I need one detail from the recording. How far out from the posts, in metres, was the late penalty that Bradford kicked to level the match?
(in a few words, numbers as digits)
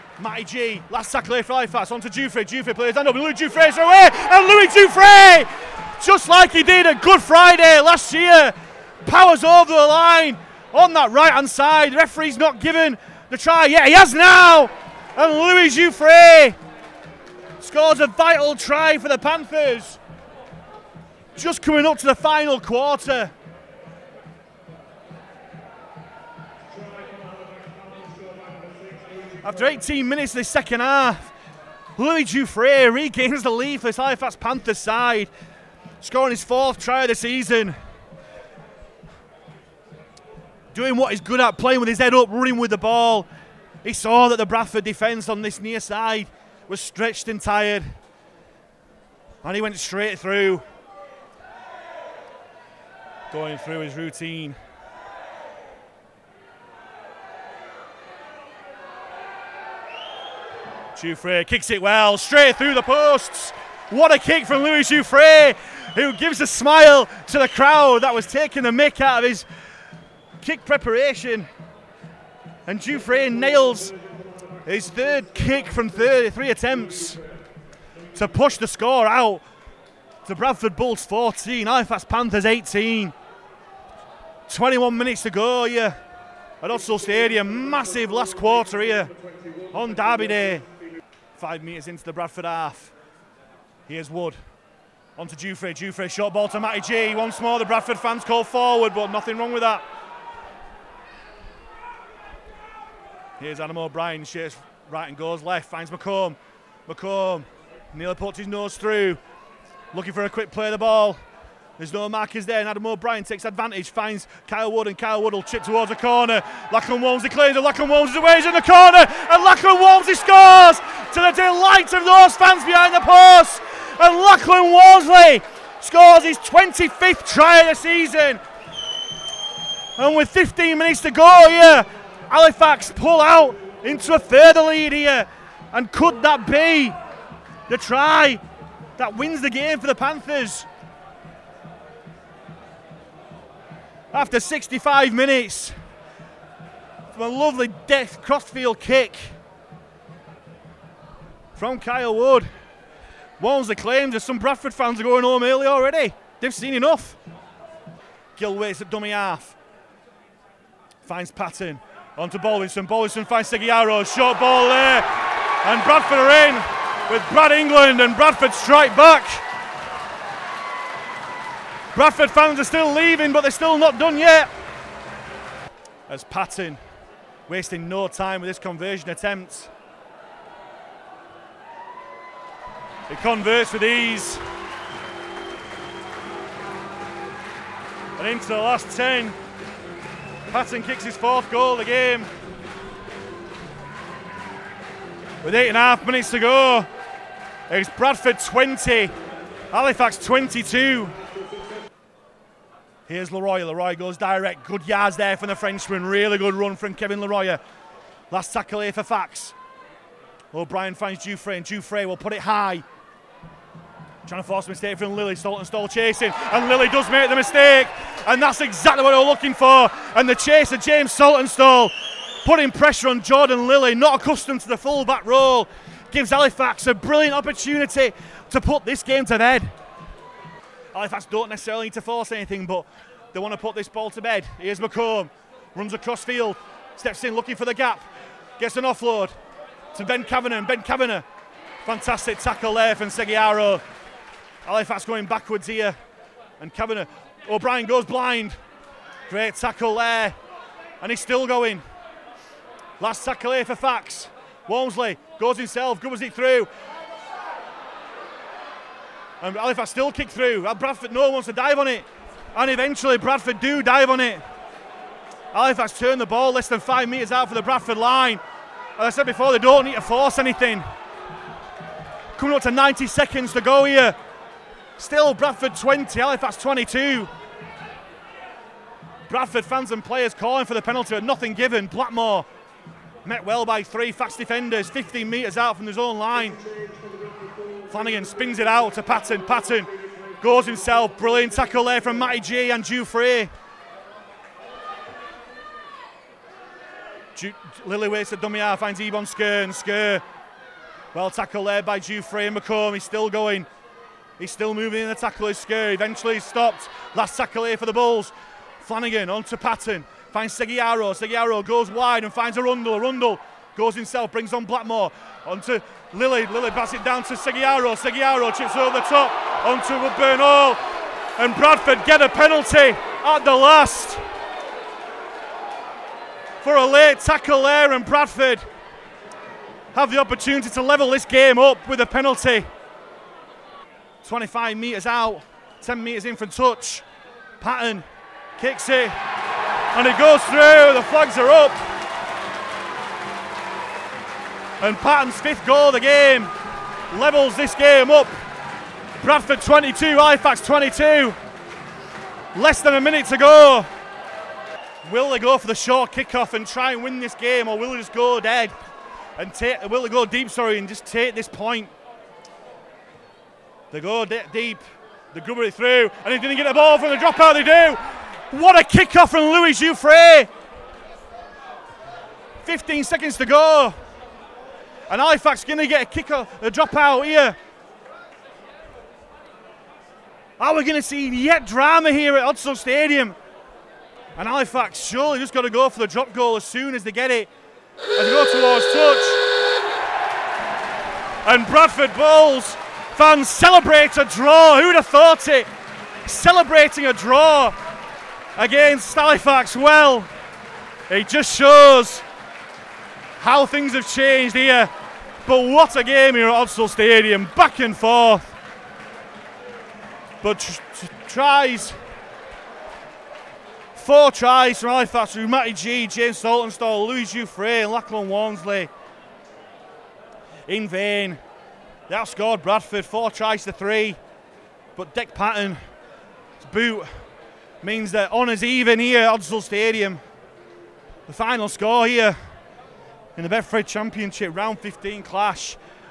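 25 metres.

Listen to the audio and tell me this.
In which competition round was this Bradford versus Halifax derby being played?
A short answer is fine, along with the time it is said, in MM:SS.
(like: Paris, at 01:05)
Round 15, at 07:14.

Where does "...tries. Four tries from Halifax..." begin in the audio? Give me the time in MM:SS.
06:51.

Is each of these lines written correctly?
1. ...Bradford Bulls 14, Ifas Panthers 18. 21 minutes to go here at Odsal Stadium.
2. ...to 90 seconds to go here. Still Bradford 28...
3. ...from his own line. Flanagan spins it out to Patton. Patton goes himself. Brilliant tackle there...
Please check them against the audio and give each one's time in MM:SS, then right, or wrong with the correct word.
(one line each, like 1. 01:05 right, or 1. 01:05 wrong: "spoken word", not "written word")
1. 01:20 right
2. 04:32 wrong: "20", not "28"
3. 04:45 right.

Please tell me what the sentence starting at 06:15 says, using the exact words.
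And Halifax going to get a kick off, a dropout here.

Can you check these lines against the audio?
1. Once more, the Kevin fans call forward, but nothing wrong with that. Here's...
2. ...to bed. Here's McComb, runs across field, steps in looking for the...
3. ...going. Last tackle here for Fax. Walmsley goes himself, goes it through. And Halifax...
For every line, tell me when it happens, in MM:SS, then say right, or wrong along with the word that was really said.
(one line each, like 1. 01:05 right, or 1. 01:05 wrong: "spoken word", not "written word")
1. 01:37 wrong: "Bradford", not "Kevin"
2. 03:54 right
3. 04:11 right.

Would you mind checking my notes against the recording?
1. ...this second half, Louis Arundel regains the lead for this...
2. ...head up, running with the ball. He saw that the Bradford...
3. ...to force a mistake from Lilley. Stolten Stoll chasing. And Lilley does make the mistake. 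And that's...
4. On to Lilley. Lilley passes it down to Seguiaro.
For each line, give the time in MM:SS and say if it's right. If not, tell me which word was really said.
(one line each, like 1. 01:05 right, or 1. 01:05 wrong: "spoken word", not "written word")
1. 00:30 wrong: "Jouffret", not "Arundel"
2. 00:41 right
3. 03:34 right
4. 05:15 right.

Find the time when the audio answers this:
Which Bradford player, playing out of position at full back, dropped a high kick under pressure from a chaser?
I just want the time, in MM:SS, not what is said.
03:43.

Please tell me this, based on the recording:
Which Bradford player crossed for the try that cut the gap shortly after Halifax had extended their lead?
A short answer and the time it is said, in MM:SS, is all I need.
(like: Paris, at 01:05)
Brad England, at 02:47.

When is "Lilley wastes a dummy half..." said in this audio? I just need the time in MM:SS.
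04:57.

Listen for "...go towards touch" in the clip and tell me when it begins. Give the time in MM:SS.
06:28.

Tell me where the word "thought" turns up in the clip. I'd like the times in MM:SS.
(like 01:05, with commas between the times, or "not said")
06:35.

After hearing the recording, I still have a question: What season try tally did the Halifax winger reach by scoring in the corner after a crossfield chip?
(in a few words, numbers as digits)
25.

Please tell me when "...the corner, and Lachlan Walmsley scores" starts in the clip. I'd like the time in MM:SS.
01:58.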